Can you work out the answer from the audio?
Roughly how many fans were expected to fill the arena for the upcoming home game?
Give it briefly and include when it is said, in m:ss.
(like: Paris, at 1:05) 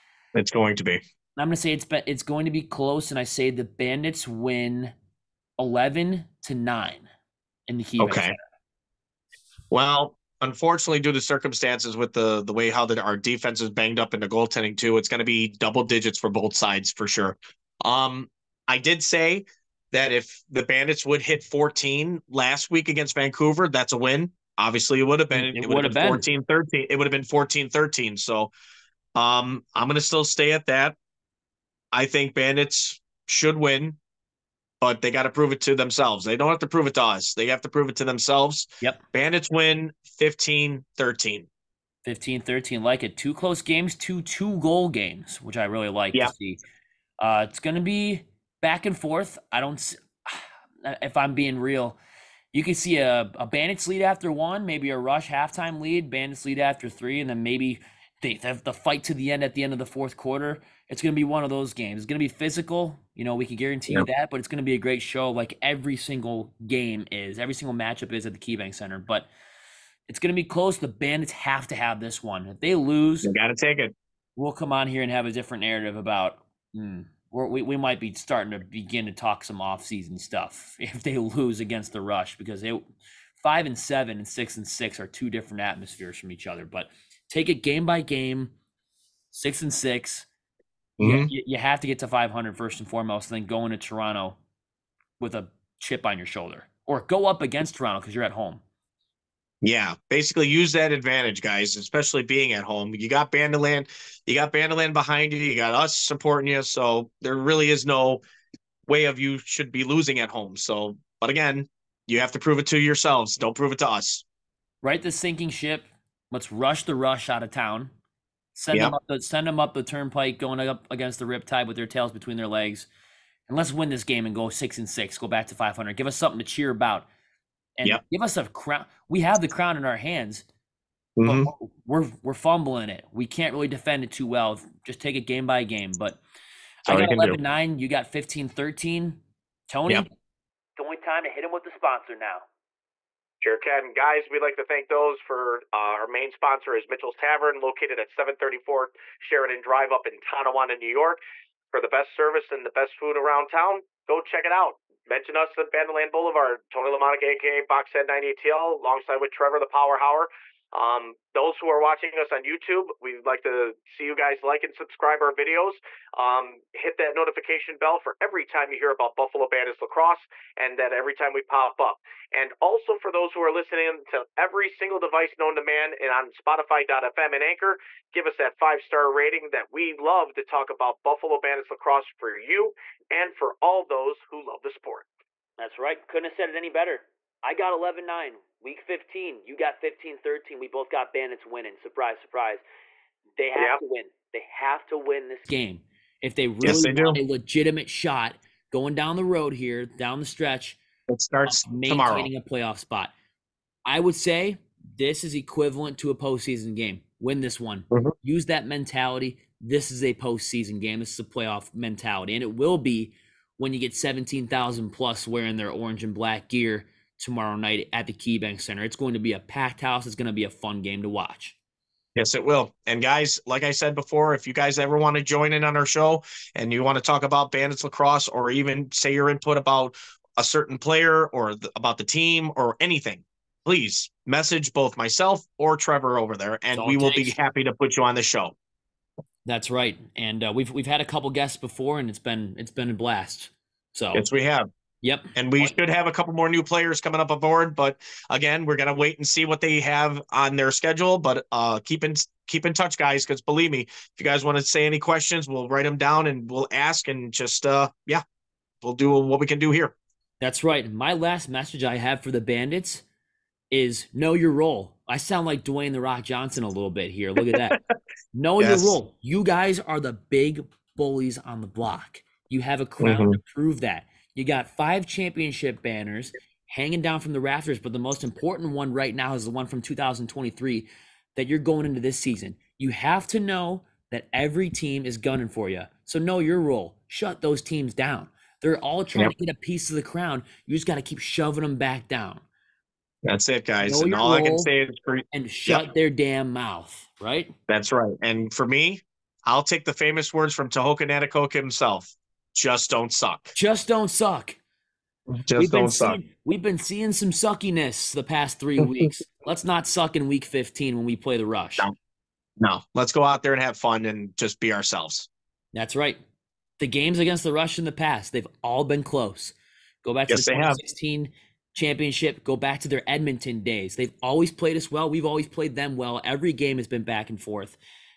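17,000, at 3:33.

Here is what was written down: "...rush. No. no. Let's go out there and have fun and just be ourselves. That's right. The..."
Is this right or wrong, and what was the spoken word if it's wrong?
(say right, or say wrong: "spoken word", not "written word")
right.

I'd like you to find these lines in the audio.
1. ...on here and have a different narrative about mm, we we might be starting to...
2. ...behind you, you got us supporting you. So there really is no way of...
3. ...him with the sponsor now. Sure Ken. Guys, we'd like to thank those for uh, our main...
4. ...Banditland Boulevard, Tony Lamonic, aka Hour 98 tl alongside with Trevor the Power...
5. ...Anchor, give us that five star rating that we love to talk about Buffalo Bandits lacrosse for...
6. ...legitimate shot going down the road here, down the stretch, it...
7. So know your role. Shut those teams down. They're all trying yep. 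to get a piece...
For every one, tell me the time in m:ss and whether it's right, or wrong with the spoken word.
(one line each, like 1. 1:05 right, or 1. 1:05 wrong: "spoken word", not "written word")
1. 1:14 right
2. 1:44 right
3. 2:21 right
4. 2:35 wrong: "Boxhead", not "Hour"
5. 2:57 right
6. 3:17 right
7. 4:46 right.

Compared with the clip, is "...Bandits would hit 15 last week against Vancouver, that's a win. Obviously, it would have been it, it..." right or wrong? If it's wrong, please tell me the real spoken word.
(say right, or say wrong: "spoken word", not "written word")
wrong: "14", not "15".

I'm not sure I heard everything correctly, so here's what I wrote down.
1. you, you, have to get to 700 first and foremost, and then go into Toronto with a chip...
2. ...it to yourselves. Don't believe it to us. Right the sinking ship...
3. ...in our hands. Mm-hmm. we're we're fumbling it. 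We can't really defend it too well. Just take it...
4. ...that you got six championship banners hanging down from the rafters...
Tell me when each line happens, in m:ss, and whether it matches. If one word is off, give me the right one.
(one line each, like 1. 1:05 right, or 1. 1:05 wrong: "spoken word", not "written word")
1. 1:31 wrong: "500", not "700"
2. 1:52 wrong: "prove", not "believe"
3. 2:09 right
4. 4:33 wrong: "five", not "six".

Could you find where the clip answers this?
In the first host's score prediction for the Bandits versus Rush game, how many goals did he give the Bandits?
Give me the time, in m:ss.
0:05.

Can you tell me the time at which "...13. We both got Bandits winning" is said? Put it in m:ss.
3:10.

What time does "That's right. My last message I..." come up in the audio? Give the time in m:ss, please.
4:20.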